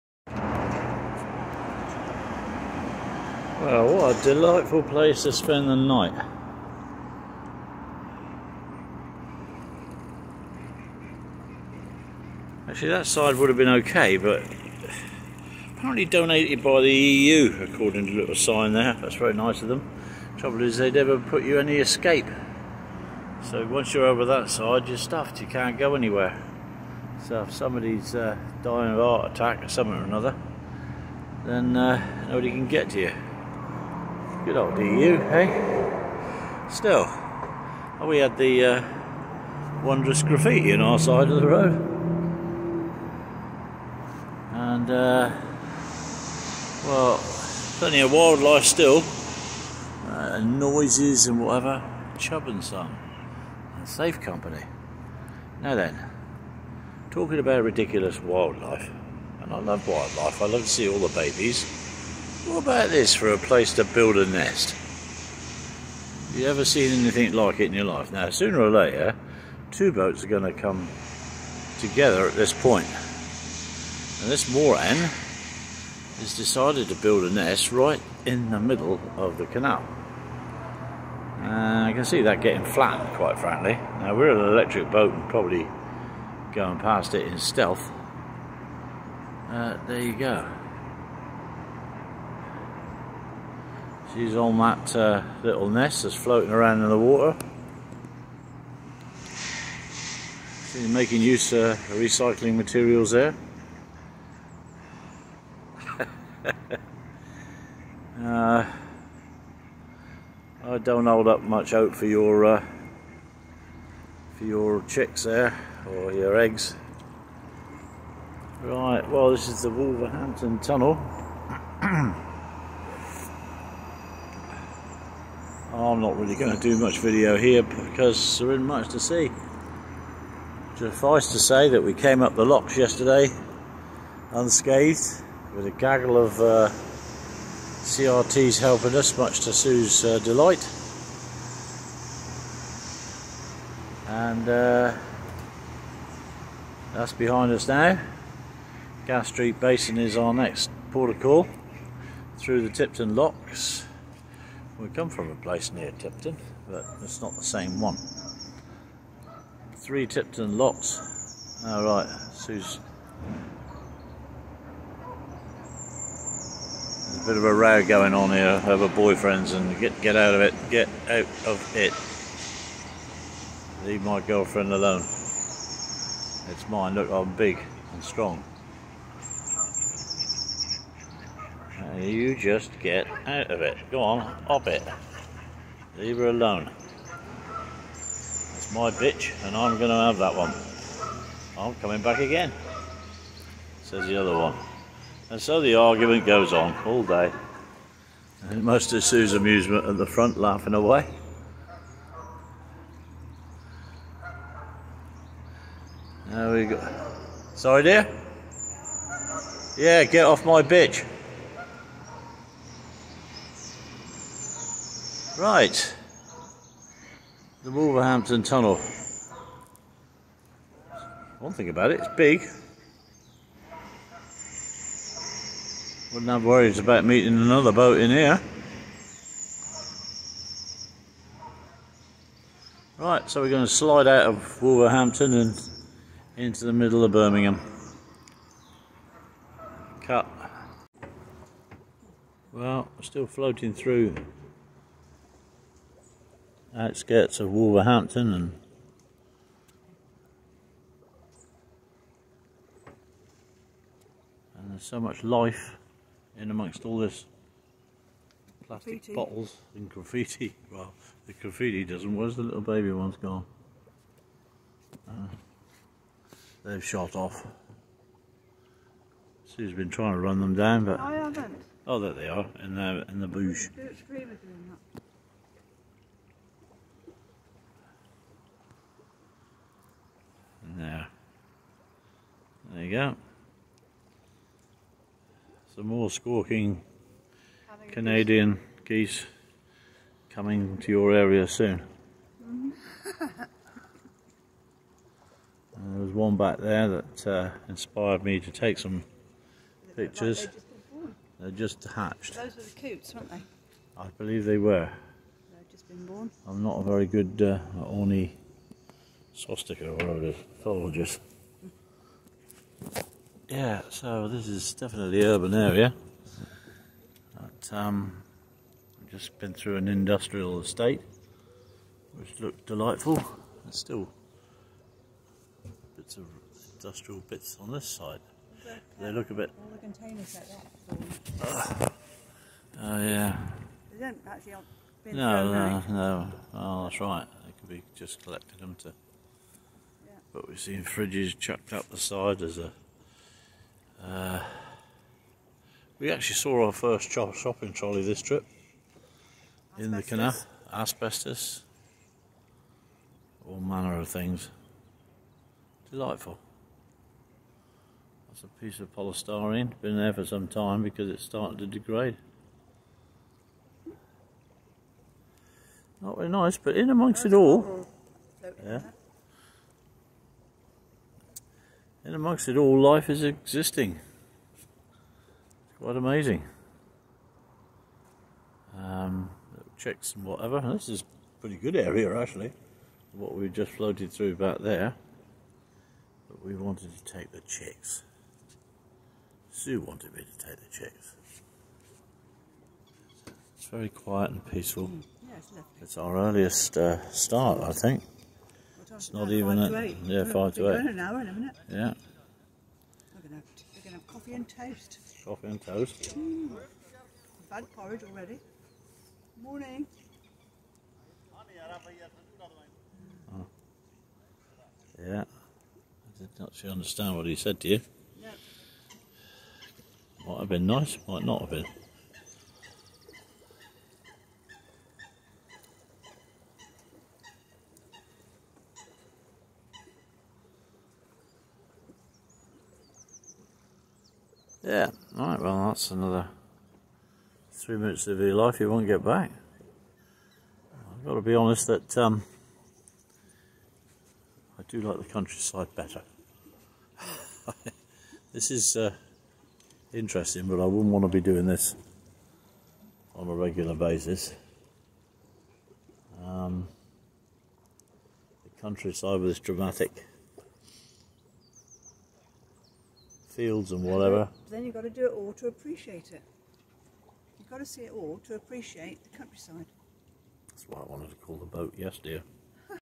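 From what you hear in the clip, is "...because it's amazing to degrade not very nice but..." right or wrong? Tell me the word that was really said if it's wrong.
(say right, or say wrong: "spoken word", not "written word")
wrong: "starting", not "amazing".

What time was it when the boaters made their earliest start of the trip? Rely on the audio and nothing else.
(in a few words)
7:55.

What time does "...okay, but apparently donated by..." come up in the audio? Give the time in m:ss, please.
0:13.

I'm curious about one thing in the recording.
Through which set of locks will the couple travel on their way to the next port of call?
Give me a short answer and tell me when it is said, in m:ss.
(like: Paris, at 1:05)
Tipton locks, at 2:32.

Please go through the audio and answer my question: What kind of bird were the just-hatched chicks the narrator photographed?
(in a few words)
Coots.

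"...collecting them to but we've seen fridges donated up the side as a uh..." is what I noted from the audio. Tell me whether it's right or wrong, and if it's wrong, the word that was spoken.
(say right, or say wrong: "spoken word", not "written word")
wrong: "chucked", not "donated".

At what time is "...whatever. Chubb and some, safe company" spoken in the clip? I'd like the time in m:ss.
0:51.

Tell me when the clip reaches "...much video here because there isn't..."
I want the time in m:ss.
2:06.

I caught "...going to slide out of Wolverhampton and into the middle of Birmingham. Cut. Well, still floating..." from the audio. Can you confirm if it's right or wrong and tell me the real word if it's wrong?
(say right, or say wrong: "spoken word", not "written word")
right.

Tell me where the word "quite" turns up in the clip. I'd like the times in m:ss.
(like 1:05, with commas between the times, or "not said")
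1:23, 6:15.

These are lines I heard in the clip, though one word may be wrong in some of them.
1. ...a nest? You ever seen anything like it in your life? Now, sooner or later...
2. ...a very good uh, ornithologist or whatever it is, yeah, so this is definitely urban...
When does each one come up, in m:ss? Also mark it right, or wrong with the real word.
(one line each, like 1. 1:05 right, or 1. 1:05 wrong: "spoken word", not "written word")
1. 1:04 right
2. 5:06 right.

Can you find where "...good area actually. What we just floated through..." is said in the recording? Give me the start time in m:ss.
6:21.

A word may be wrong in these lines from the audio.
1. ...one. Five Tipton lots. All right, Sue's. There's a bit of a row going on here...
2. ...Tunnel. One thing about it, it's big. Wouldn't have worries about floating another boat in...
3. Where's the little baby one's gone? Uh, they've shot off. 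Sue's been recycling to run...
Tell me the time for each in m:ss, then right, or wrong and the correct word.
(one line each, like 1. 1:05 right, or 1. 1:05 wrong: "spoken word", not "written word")
1. 2:37 wrong: "Three", not "Five"
2. 3:38 wrong: "meeting", not "floating"
3. 4:22 wrong: "trying", not "recycling".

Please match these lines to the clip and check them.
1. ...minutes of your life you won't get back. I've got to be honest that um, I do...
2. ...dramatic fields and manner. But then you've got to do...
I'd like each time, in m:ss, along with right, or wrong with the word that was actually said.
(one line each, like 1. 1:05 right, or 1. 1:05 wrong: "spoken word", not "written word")
1. 7:17 right
2. 7:39 wrong: "whatever", not "manner".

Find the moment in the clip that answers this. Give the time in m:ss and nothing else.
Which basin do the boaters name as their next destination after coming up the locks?
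2:29.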